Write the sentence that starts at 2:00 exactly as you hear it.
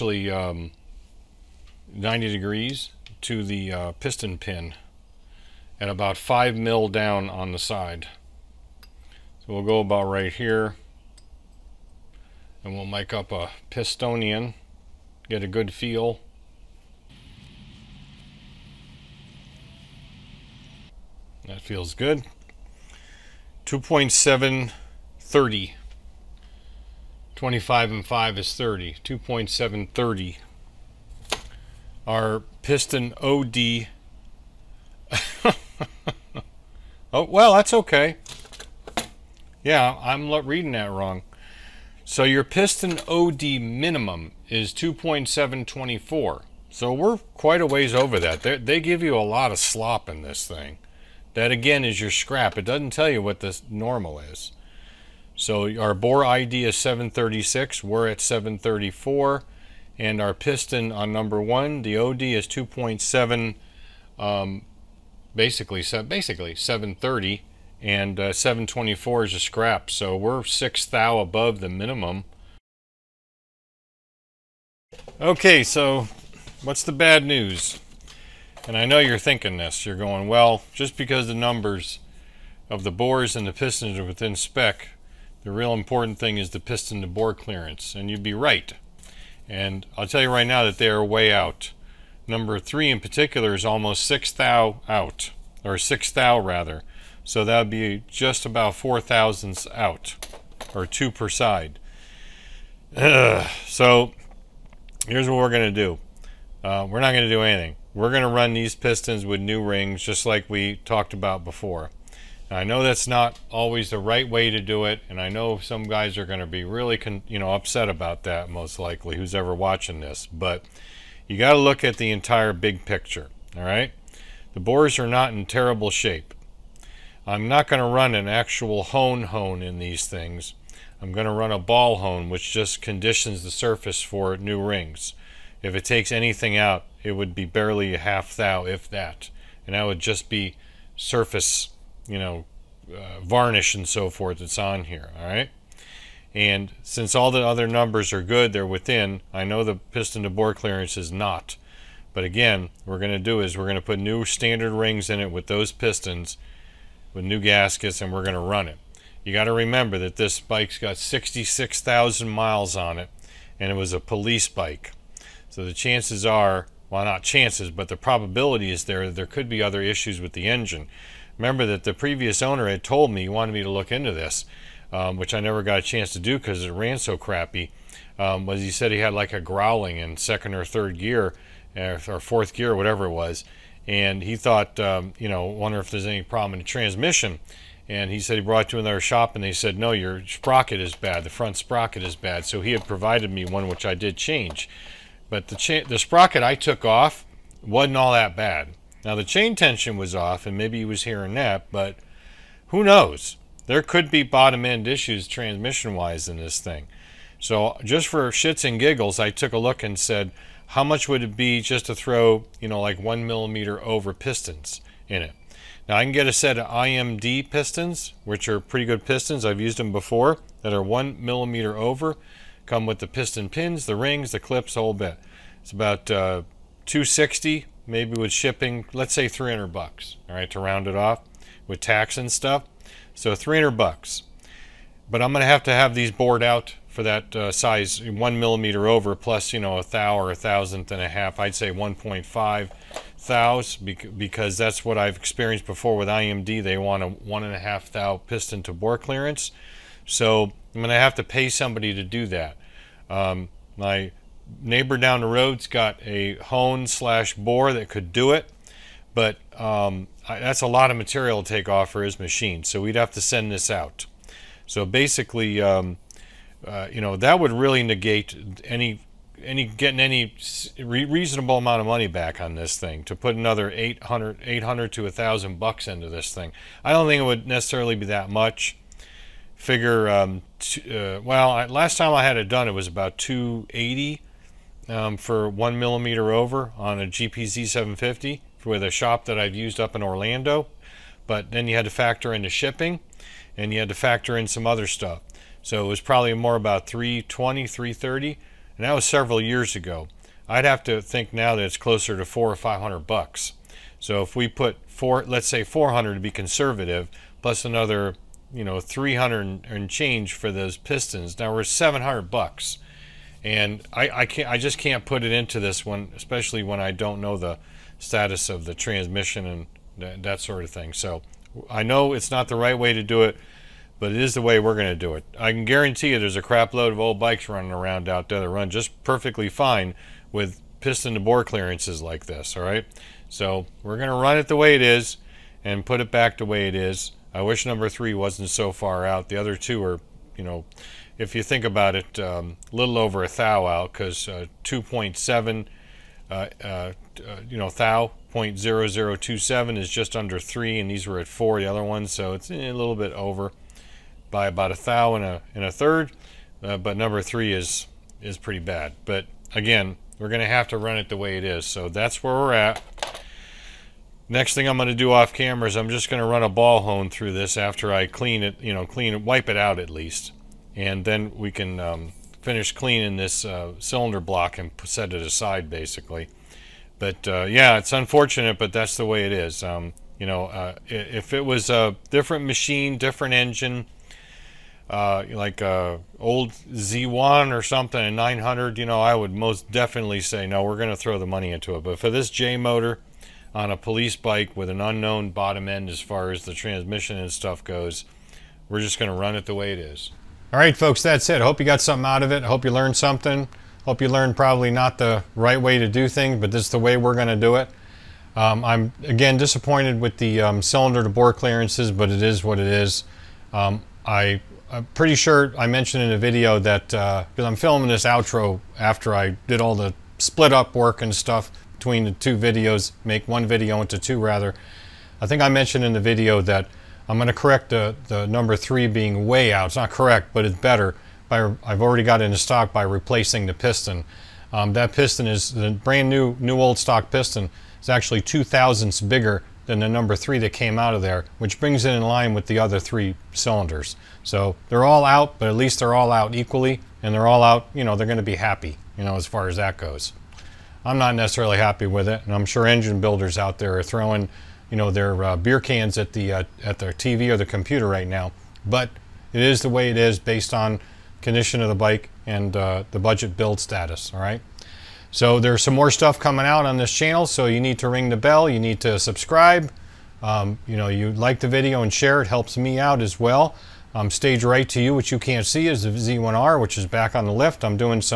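But you got to look at the entire big picture, all right?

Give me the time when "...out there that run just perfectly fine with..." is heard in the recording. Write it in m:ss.
5:28.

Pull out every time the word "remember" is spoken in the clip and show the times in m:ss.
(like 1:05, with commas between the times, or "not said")
2:39, 2:51.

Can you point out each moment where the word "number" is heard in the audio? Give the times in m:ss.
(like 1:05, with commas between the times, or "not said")
1:01, 1:21, 1:32, 2:27, 5:37, 5:56, 7:08, 7:19.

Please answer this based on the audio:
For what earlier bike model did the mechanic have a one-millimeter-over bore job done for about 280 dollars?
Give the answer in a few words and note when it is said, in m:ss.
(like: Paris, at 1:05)
GPZ 750, at 4:47.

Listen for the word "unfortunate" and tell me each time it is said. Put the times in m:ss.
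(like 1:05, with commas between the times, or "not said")
6:17.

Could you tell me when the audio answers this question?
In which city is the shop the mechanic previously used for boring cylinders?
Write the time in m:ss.
4:50.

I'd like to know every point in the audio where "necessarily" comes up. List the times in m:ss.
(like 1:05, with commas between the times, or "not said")
4:37, 7:31.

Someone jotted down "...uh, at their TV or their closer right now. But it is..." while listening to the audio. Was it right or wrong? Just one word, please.
wrong.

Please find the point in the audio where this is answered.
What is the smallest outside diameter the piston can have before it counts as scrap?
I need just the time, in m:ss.
0:44.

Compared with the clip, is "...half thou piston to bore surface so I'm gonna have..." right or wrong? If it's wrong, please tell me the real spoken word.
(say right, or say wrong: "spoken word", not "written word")
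wrong: "clearance", not "surface".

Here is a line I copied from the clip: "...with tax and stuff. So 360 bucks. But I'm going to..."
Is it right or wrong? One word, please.
wrong.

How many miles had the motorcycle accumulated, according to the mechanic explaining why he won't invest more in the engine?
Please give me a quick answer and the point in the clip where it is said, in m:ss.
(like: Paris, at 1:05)
66,000, at 2:40.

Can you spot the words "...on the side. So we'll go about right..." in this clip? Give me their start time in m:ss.
0:07.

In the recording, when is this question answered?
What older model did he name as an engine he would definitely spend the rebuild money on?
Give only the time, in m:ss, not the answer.
6:26.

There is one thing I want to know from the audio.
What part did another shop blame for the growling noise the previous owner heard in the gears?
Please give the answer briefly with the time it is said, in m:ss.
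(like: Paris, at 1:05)
Front sprocket, at 3:11.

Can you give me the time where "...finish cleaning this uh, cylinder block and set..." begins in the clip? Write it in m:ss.
6:12.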